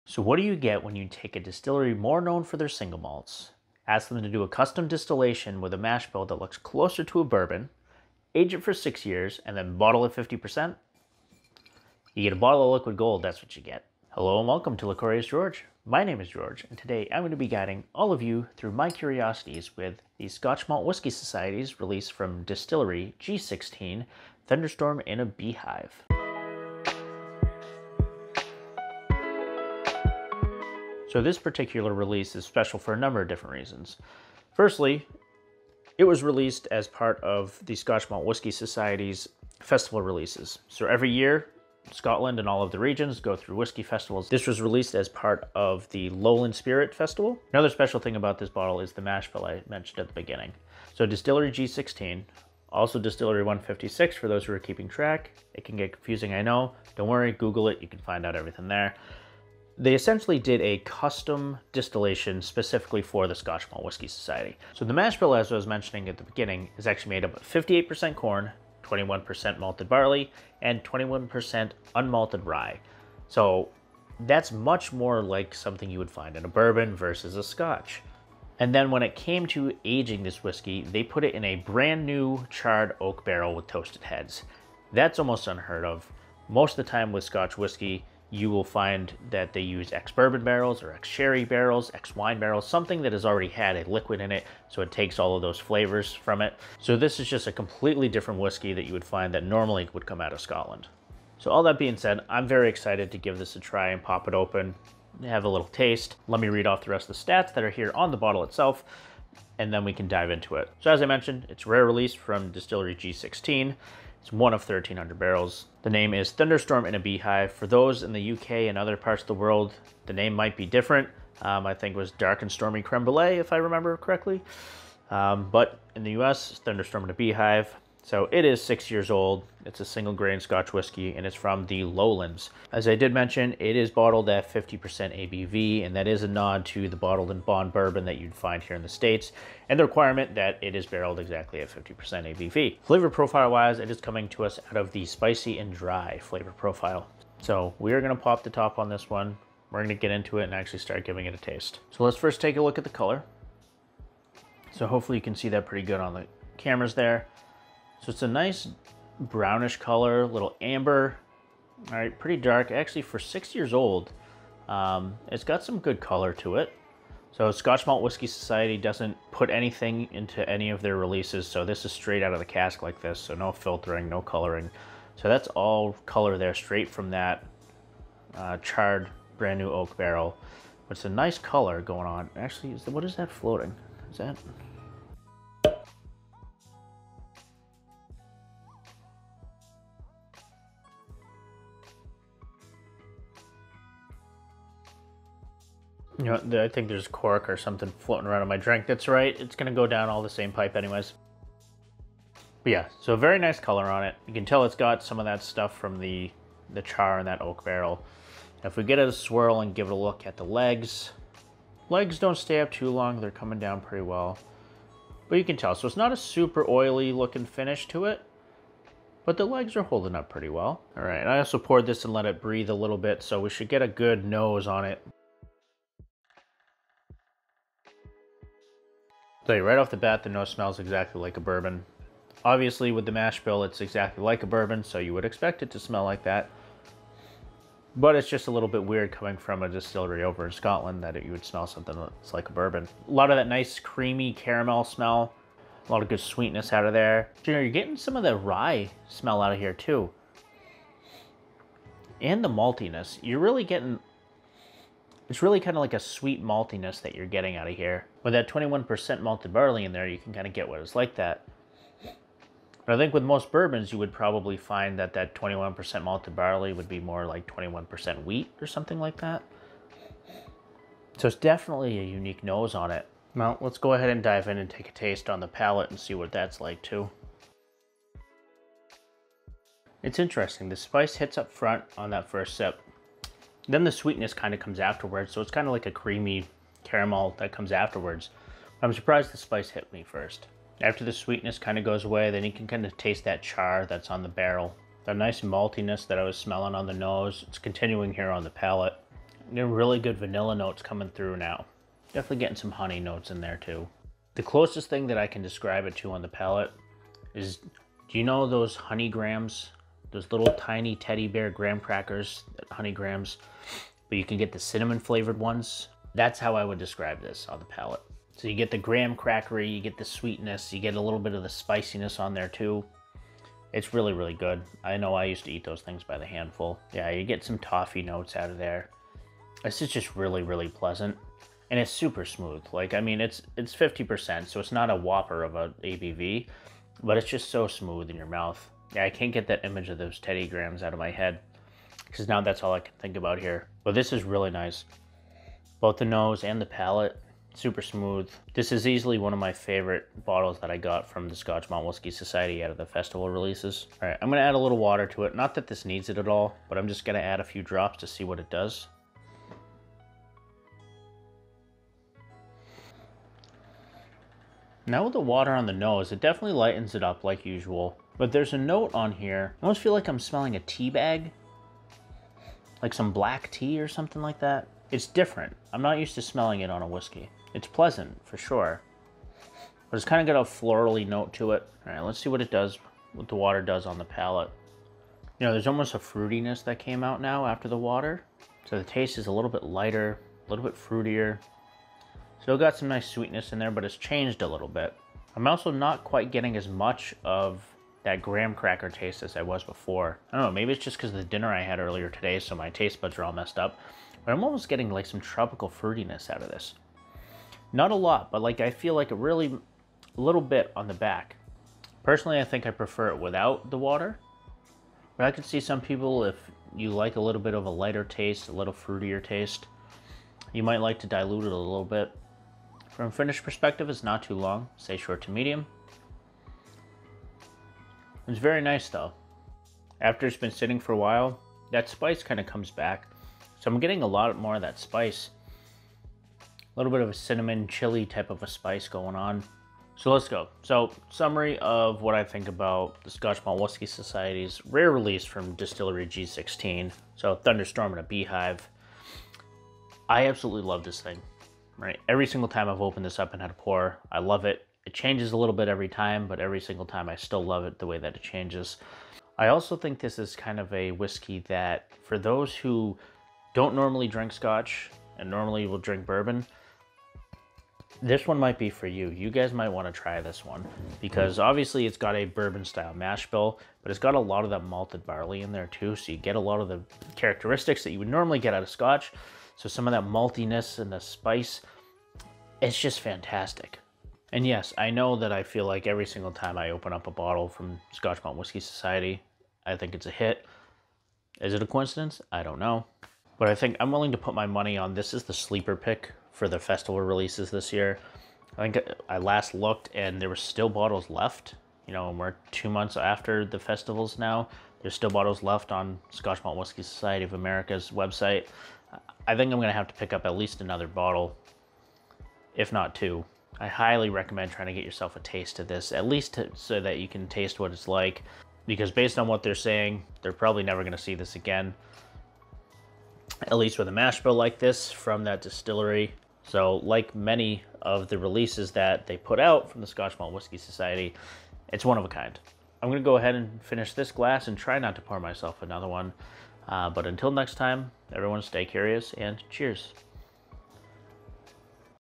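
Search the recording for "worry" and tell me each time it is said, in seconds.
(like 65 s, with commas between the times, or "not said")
57 s.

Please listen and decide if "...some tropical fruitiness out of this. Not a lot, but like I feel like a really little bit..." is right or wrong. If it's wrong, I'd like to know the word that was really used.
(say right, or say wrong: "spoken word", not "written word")
right.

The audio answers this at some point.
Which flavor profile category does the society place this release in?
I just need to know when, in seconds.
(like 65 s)
145 s.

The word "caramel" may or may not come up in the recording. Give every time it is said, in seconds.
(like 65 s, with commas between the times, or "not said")
244 s, 286 s.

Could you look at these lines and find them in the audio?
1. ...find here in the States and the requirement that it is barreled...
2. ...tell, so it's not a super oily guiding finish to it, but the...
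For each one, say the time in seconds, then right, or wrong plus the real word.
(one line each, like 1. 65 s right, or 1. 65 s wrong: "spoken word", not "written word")
1. 138 s right
2. 215 s wrong: "looking", not "guiding".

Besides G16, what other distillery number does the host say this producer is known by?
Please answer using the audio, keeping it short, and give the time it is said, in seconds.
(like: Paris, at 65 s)
156, at 52 s.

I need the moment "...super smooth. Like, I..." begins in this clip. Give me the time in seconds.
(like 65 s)
331 s.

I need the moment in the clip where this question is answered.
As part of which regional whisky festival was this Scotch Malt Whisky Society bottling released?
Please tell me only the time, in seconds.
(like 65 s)
46 s.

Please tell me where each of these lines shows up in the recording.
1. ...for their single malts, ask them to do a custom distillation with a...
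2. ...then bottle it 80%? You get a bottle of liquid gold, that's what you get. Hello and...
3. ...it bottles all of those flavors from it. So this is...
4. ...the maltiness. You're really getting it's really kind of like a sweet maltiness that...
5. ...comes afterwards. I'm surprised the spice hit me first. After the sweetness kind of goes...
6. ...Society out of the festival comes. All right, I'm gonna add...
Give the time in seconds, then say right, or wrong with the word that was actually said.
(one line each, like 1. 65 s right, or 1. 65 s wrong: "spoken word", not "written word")
1. 2 s right
2. 9 s wrong: "50", not "80"
3. 94 s wrong: "takes", not "bottles"
4. 252 s right
5. 287 s right
6. 352 s wrong: "releases", not "comes".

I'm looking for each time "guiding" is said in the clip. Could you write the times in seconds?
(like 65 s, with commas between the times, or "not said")
17 s.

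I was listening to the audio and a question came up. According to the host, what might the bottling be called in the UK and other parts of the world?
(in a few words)
Dark and Stormy Creme Brulee.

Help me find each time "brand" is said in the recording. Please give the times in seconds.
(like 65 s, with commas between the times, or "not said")
81 s, 179 s.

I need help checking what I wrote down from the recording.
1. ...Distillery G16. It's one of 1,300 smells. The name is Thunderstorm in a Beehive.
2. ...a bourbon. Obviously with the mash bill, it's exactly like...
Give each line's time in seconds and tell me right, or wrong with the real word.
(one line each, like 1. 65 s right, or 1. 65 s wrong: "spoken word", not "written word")
1. 112 s wrong: "barrels", not "smells"
2. 231 s right.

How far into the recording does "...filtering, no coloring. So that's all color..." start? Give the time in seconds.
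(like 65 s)
173 s.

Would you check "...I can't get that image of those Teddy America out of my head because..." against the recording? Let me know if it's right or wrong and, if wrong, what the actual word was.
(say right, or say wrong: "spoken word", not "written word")
wrong: "Grahams", not "America".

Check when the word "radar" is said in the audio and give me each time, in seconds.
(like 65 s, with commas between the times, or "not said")
not said.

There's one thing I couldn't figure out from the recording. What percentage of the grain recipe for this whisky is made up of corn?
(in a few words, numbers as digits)
58%.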